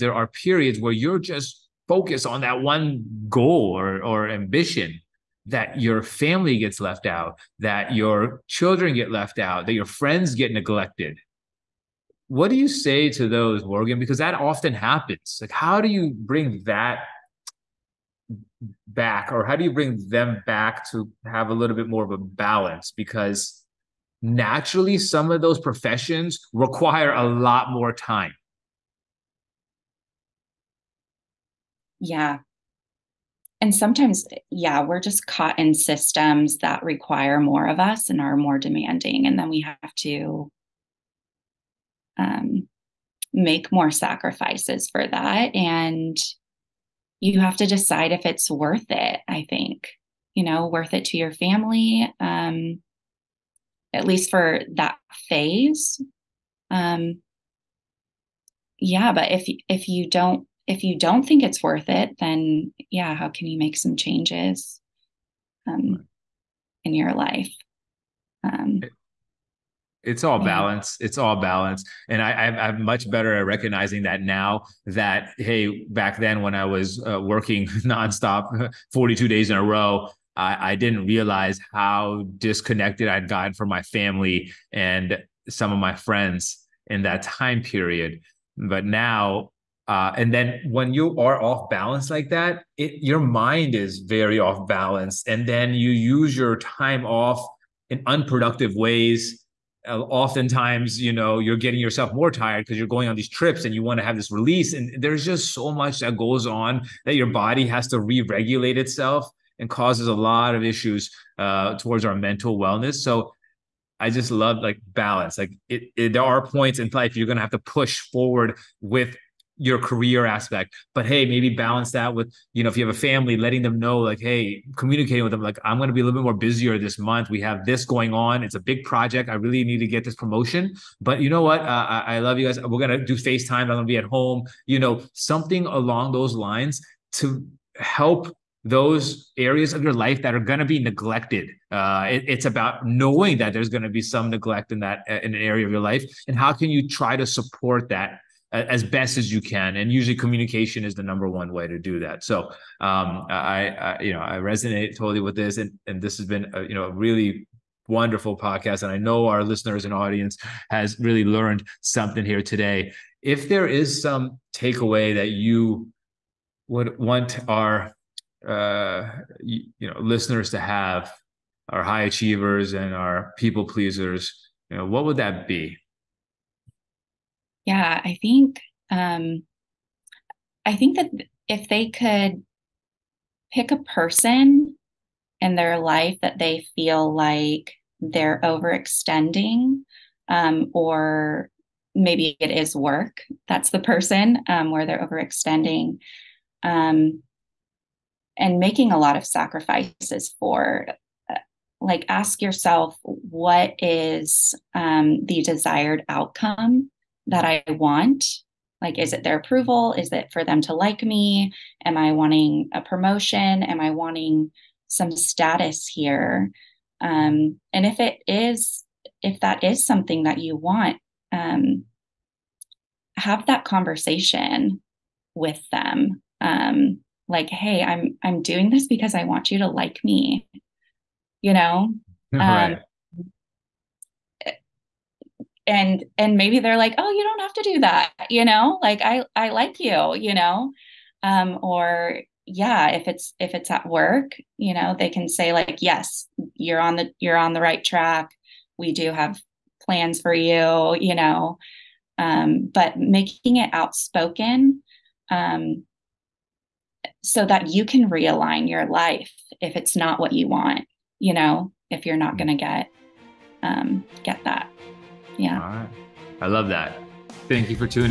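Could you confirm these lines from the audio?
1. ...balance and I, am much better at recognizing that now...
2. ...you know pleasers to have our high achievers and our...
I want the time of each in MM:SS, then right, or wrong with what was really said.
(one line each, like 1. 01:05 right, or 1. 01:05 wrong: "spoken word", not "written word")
1. 01:11 right
2. 02:49 wrong: "listeners", not "pleasers".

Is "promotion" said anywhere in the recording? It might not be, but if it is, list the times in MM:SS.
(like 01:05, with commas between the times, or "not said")
02:10, 03:32.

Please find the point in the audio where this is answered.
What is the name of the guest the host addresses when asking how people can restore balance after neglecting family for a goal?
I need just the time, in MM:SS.
00:13.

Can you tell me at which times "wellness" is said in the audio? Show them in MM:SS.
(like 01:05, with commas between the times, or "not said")
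01:52.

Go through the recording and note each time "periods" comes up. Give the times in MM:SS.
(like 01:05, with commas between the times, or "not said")
00:00, 01:27.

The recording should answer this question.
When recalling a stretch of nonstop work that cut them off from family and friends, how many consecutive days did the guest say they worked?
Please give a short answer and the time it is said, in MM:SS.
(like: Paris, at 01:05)
42, at 01:18.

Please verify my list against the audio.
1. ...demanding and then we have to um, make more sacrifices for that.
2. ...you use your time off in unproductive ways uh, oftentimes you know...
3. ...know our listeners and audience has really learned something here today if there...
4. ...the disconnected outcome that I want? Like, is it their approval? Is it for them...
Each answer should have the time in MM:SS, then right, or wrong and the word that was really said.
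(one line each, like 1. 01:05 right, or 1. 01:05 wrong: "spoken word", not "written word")
1. 00:38 right
2. 01:35 right
3. 02:38 right
4. 03:25 wrong: "desired", not "disconnected".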